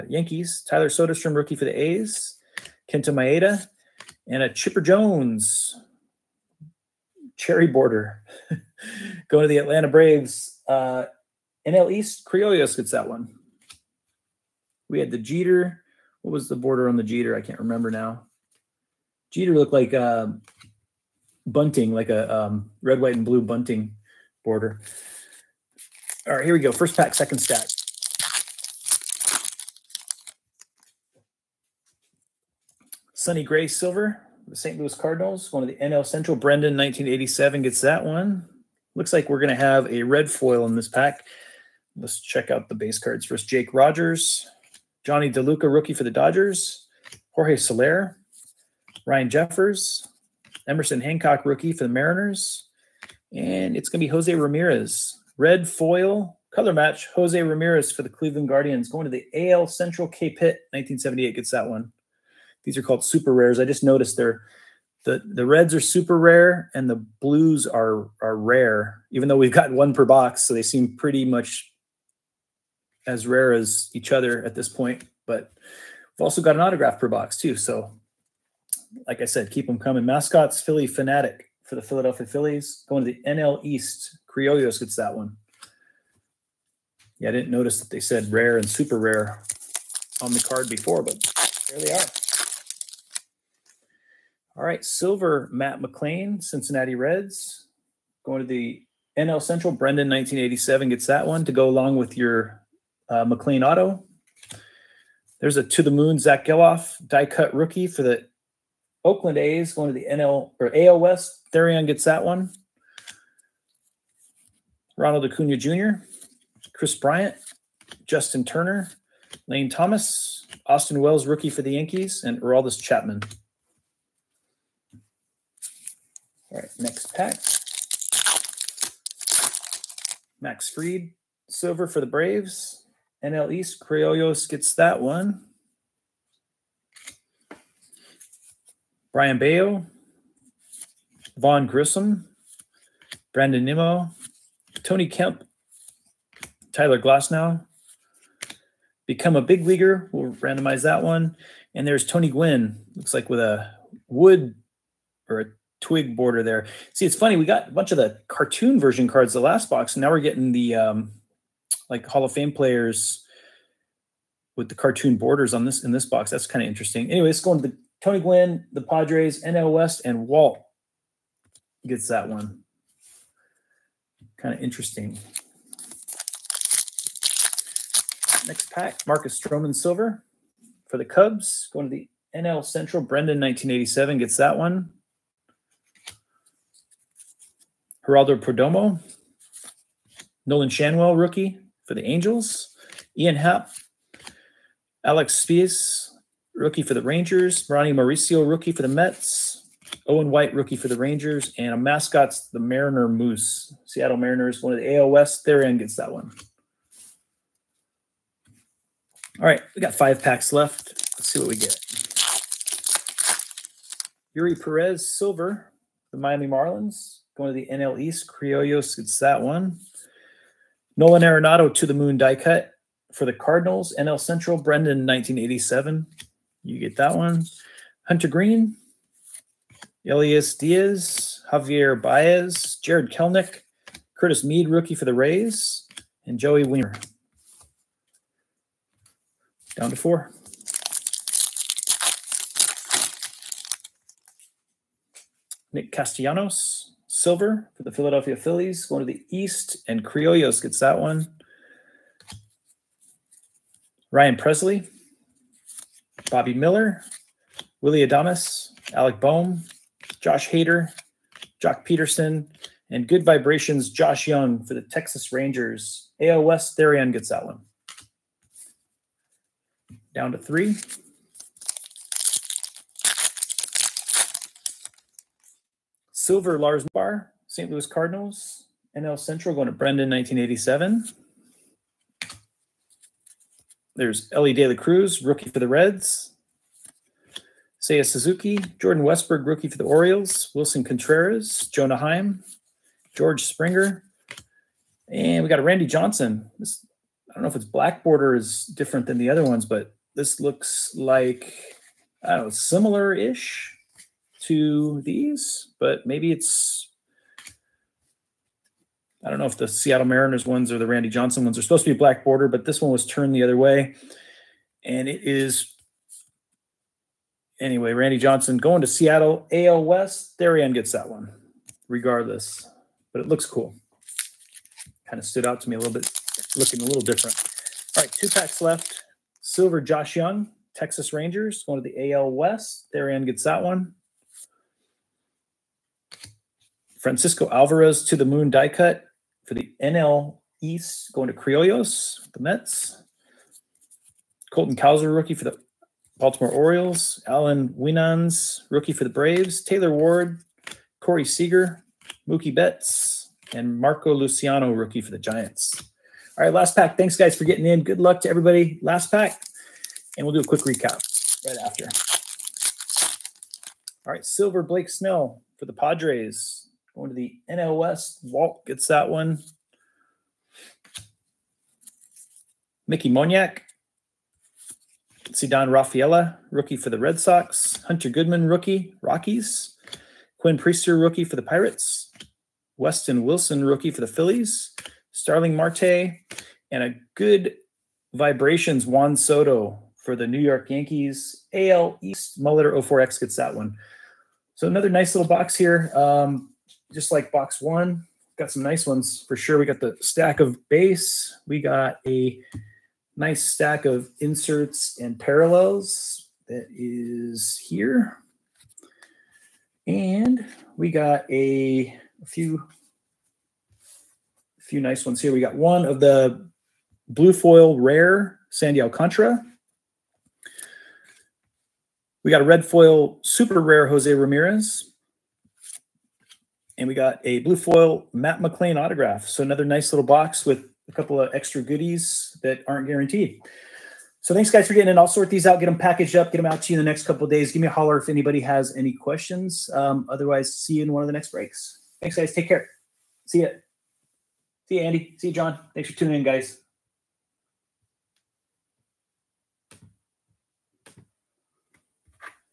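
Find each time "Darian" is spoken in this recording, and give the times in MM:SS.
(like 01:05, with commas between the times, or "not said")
05:20, 05:32.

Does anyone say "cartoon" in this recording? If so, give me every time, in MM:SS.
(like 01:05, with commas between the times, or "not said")
02:38, 02:44.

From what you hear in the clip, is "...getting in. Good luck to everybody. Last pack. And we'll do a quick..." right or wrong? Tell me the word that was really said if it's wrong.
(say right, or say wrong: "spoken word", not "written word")
right.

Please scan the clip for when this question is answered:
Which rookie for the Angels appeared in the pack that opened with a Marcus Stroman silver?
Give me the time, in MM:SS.
03:10.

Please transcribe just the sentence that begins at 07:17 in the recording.
Give me a holler if anybody has any questions.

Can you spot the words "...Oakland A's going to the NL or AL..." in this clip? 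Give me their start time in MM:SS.
01:49.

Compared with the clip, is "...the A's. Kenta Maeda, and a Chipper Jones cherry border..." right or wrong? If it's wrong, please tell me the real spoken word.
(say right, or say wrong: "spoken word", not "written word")
right.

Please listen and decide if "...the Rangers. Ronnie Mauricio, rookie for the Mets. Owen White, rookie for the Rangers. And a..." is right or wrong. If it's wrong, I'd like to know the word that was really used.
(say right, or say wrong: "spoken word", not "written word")
right.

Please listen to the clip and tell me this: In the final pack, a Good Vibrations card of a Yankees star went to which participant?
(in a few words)
Muller 04X.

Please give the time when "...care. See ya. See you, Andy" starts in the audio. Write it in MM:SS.
07:22.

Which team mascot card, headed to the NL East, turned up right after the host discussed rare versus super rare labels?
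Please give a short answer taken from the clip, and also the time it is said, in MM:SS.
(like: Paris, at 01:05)
Phillie Phanatic, at 01:20.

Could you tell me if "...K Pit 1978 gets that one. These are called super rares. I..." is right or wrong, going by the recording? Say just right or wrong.
right.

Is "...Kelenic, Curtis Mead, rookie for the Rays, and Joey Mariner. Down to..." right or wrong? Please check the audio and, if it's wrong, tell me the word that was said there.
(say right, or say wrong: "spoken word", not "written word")
wrong: "Wiemer", not "Mariner".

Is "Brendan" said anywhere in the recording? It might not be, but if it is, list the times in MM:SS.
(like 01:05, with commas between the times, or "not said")
00:36, 01:39, 03:03, 03:44, 04:39.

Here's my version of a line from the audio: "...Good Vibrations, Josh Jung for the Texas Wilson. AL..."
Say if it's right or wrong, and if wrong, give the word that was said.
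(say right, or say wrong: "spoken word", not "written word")
wrong: "Rangers", not "Wilson".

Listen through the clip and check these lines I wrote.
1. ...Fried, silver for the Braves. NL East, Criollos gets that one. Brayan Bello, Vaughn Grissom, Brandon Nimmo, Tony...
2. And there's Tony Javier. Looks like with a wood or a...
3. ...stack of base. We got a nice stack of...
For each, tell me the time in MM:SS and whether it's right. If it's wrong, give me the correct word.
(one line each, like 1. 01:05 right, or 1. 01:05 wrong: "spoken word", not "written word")
1. 02:10 right
2. 02:31 wrong: "Gwynn", not "Javier"
3. 06:40 right.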